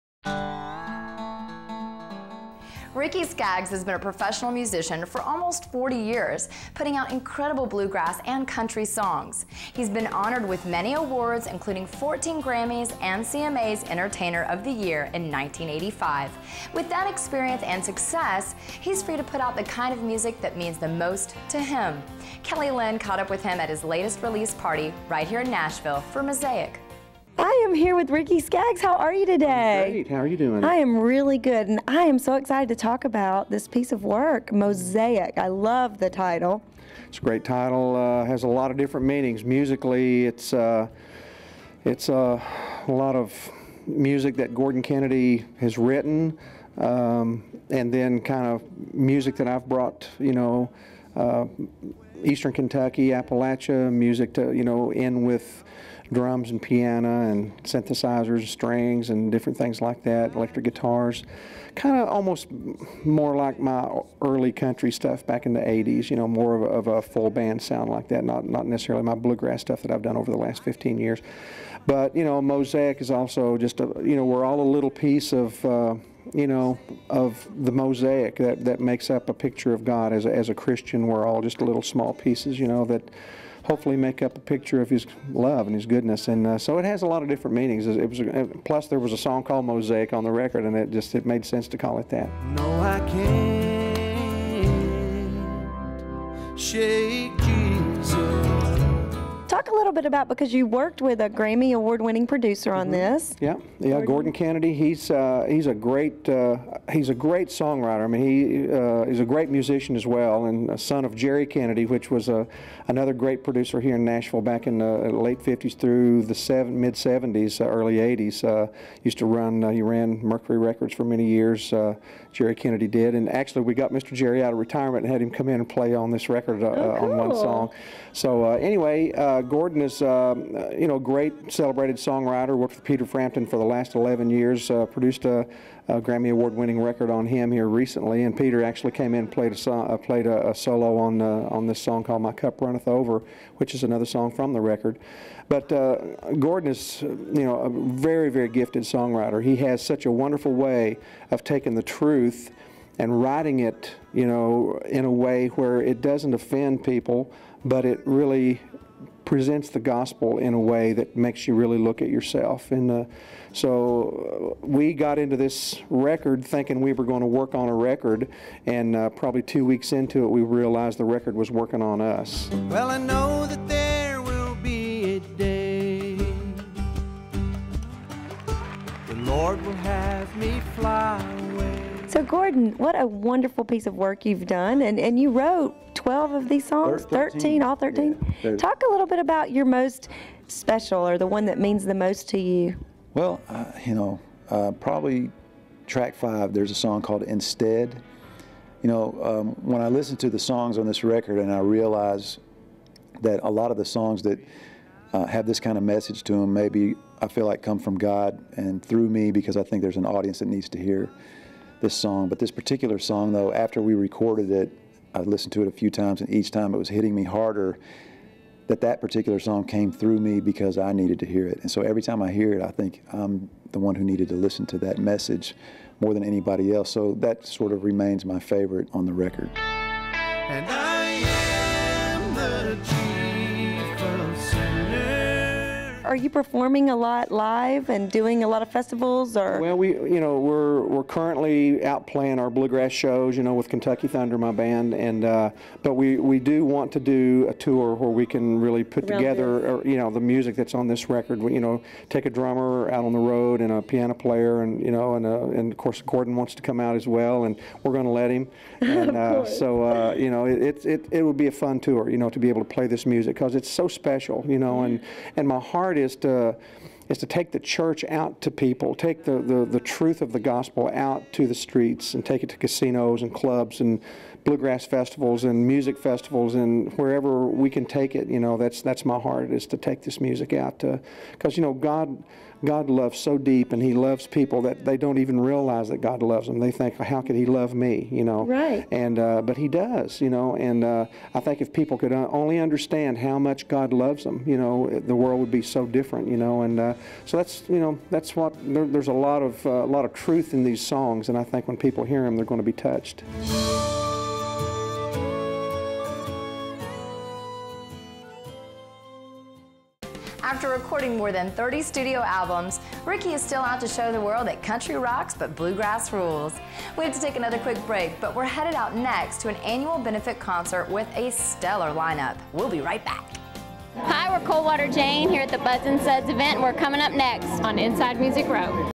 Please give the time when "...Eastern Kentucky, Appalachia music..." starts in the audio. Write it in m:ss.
0:52.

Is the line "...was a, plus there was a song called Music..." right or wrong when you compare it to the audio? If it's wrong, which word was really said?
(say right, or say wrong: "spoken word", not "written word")
wrong: "Mosaic", not "Music".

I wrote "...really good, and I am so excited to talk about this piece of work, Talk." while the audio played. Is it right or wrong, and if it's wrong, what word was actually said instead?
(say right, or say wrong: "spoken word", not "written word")
wrong: "Mosaic", not "Talk".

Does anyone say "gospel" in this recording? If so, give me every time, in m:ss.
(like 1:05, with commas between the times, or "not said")
2:39, 4:30.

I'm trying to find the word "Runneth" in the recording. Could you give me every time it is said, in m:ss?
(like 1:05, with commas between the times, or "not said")
2:22.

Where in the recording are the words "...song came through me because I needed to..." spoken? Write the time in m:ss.
3:39.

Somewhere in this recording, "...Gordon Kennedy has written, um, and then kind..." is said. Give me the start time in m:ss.
0:44.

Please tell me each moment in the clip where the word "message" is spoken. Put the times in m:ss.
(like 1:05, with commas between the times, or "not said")
3:25, 3:44.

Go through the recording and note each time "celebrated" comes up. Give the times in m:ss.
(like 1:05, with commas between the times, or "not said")
2:11.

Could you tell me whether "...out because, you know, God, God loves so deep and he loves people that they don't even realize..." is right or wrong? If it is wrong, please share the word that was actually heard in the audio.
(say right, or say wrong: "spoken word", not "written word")
right.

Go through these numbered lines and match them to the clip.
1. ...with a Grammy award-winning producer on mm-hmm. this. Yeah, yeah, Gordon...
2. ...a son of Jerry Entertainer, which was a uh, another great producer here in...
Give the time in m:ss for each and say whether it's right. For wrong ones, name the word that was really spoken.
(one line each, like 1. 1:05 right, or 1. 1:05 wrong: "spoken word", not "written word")
1. 1:41 right
2. 1:50 wrong: "Kennedy", not "Entertainer".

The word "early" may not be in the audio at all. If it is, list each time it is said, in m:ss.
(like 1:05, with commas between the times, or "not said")
1:04, 1:57.